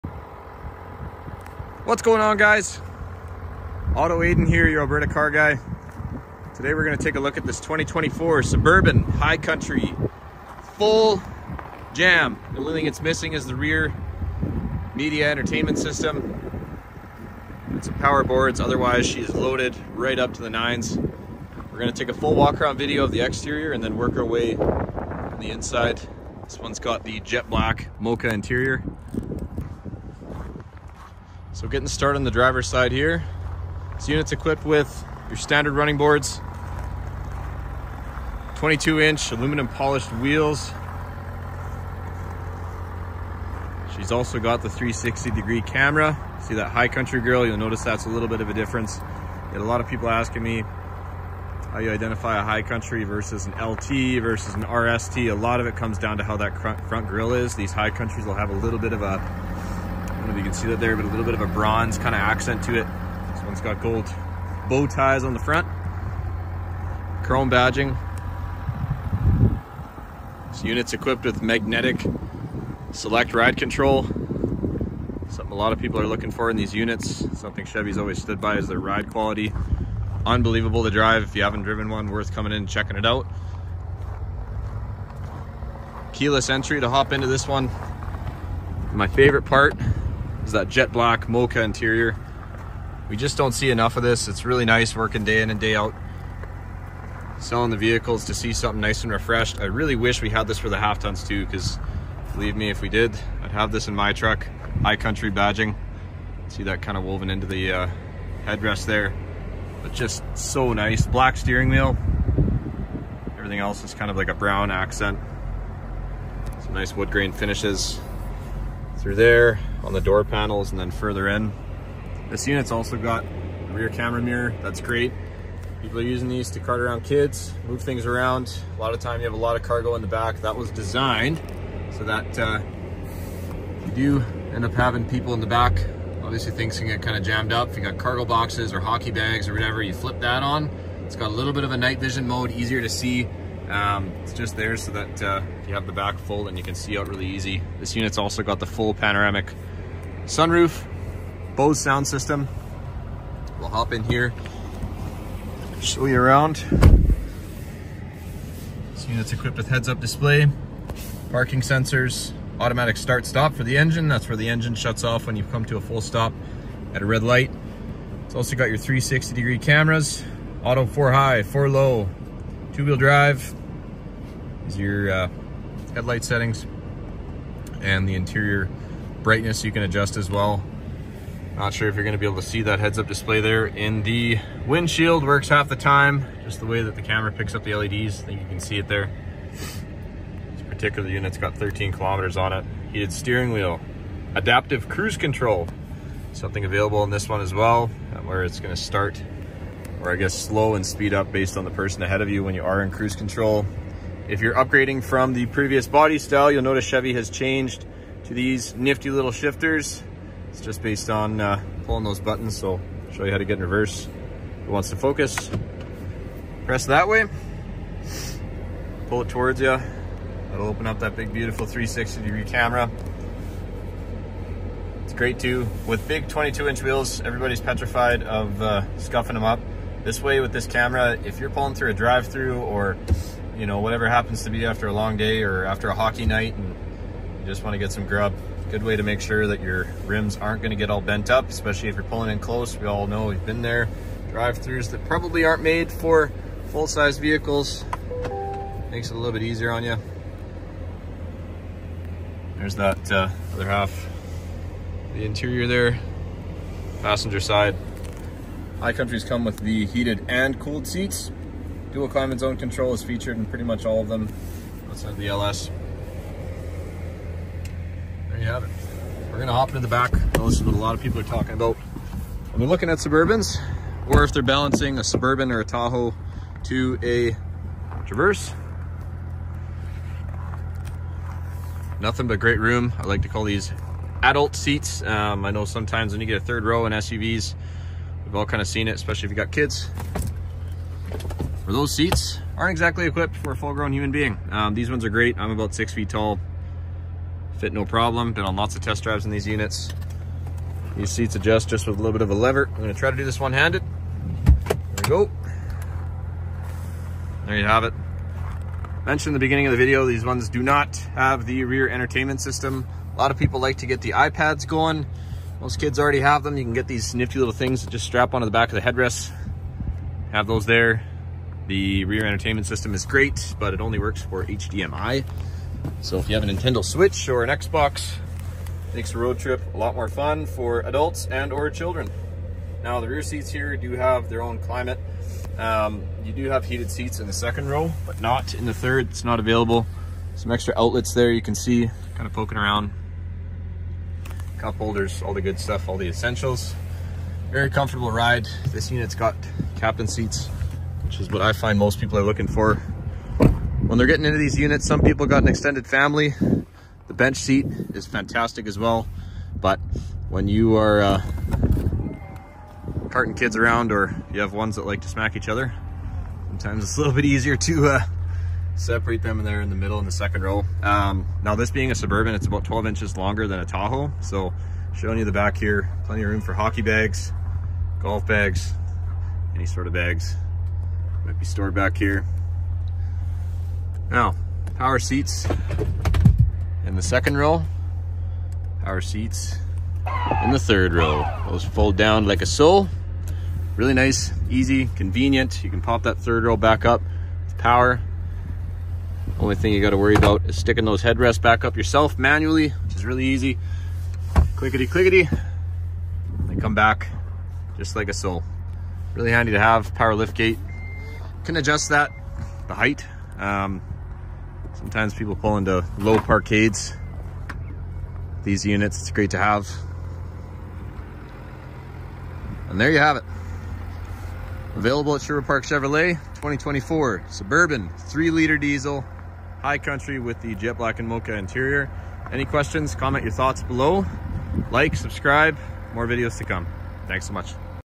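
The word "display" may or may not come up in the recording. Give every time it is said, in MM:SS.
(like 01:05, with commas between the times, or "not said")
02:39, 03:03.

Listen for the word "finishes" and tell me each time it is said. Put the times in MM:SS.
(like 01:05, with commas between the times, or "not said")
01:57.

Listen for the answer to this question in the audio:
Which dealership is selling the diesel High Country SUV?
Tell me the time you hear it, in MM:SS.
07:05.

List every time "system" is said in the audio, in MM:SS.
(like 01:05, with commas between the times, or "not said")
00:15, 02:32, 05:12, 05:22.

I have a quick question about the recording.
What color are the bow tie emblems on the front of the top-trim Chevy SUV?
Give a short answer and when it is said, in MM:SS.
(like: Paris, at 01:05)
Gold, at 01:03.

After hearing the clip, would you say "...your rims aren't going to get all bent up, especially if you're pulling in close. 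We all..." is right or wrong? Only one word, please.
right.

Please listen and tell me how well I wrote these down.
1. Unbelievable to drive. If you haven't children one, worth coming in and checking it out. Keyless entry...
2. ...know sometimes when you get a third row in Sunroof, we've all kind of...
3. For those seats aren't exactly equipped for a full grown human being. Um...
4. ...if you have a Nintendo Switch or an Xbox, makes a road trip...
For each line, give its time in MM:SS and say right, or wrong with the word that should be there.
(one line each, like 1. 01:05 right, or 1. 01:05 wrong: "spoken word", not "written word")
1. 01:20 wrong: "driven", not "children"
2. 04:45 wrong: "SUVs", not "Sunroof"
3. 04:51 right
4. 05:26 right.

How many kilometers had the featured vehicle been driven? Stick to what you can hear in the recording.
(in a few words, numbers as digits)
13.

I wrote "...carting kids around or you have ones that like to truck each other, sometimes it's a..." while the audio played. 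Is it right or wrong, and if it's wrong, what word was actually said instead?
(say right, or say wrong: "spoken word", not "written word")
wrong: "smack", not "truck".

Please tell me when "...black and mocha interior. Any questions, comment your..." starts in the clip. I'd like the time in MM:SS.
07:10.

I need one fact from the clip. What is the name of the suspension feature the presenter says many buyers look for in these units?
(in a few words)
Magnetic select ride control.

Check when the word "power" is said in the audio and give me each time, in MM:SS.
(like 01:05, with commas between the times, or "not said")
00:17, 06:24, 06:28, 06:37, 06:49.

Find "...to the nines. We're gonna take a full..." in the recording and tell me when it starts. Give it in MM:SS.
00:20.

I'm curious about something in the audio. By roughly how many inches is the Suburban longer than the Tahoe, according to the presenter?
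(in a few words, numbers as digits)
12.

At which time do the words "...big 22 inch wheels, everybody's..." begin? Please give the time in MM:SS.
03:46.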